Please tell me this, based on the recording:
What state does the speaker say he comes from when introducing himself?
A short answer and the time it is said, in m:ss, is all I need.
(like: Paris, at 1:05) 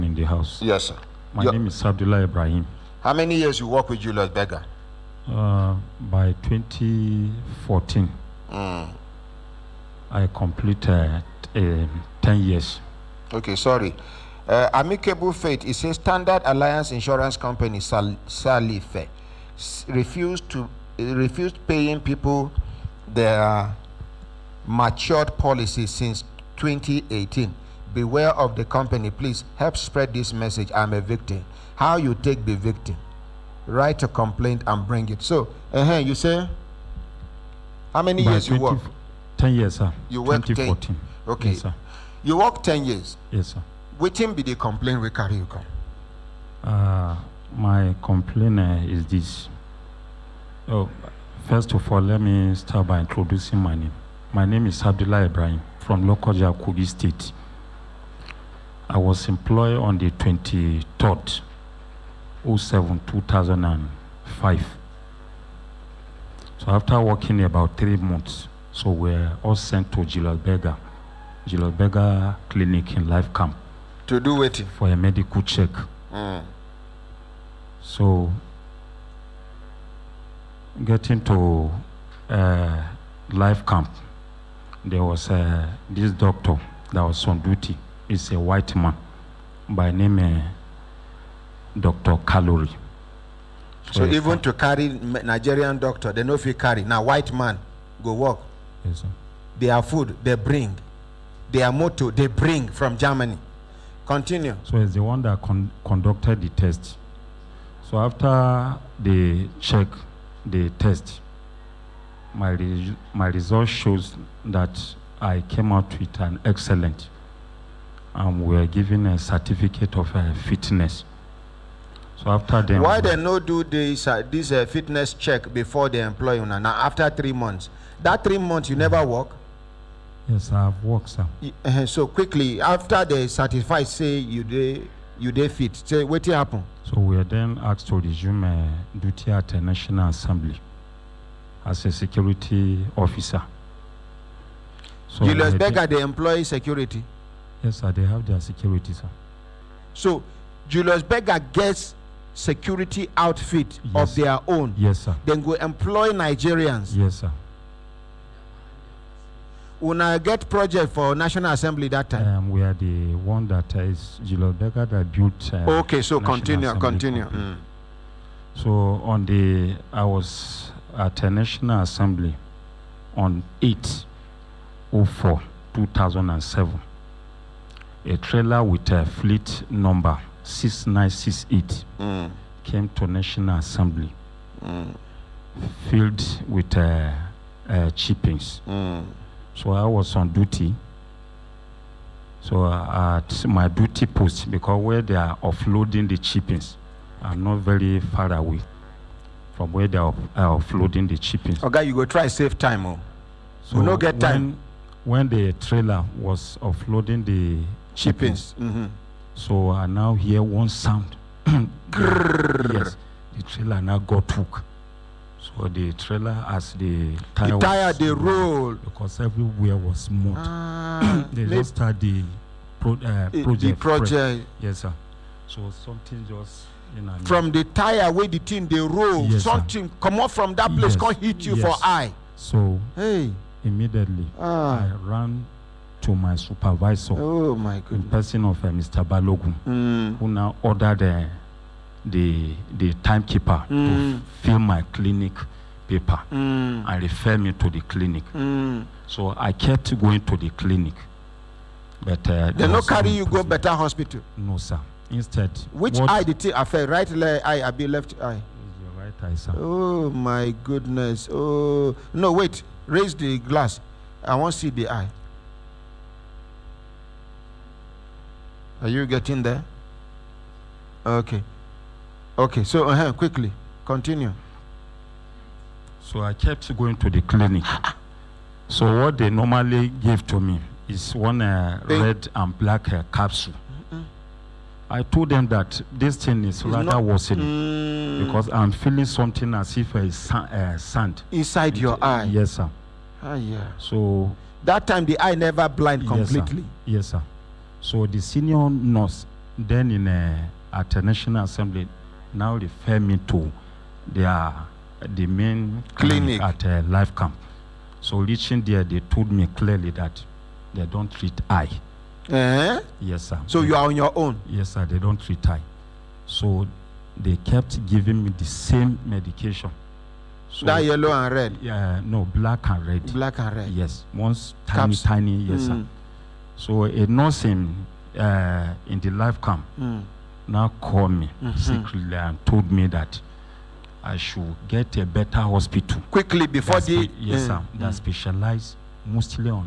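Kogi State, at 0:56.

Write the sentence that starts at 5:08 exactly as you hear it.
So reaching there, they told me clearly that they don't treat eye.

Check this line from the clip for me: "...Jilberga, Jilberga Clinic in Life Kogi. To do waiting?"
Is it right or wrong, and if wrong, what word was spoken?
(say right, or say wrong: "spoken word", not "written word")
wrong: "Camp", not "Kogi".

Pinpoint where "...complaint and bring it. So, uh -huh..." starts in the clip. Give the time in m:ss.
0:34.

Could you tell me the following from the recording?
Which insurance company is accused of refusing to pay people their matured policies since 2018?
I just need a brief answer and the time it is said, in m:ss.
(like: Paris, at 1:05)
Standard Alliance Insurance, at 0:15.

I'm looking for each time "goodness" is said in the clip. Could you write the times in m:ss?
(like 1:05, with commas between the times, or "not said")
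3:57, 4:20.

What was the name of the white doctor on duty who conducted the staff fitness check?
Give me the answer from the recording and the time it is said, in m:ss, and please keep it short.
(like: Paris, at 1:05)
Dr. Calorie, at 1:31.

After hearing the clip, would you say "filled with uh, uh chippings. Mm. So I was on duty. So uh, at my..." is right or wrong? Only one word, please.
right.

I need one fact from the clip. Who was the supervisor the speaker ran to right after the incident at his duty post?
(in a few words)
Mr. Balogun.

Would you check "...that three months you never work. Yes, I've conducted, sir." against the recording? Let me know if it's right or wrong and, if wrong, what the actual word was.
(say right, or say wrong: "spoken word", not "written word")
wrong: "worked", not "conducted".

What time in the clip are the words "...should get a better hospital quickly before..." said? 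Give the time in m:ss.
5:34.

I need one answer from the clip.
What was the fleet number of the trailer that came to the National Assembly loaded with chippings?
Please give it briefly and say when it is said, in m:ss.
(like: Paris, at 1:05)
6968, at 3:00.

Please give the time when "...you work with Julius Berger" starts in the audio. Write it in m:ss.
0:03.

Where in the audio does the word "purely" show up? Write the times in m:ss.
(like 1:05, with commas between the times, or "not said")
not said.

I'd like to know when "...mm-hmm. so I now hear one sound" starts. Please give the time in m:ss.
3:28.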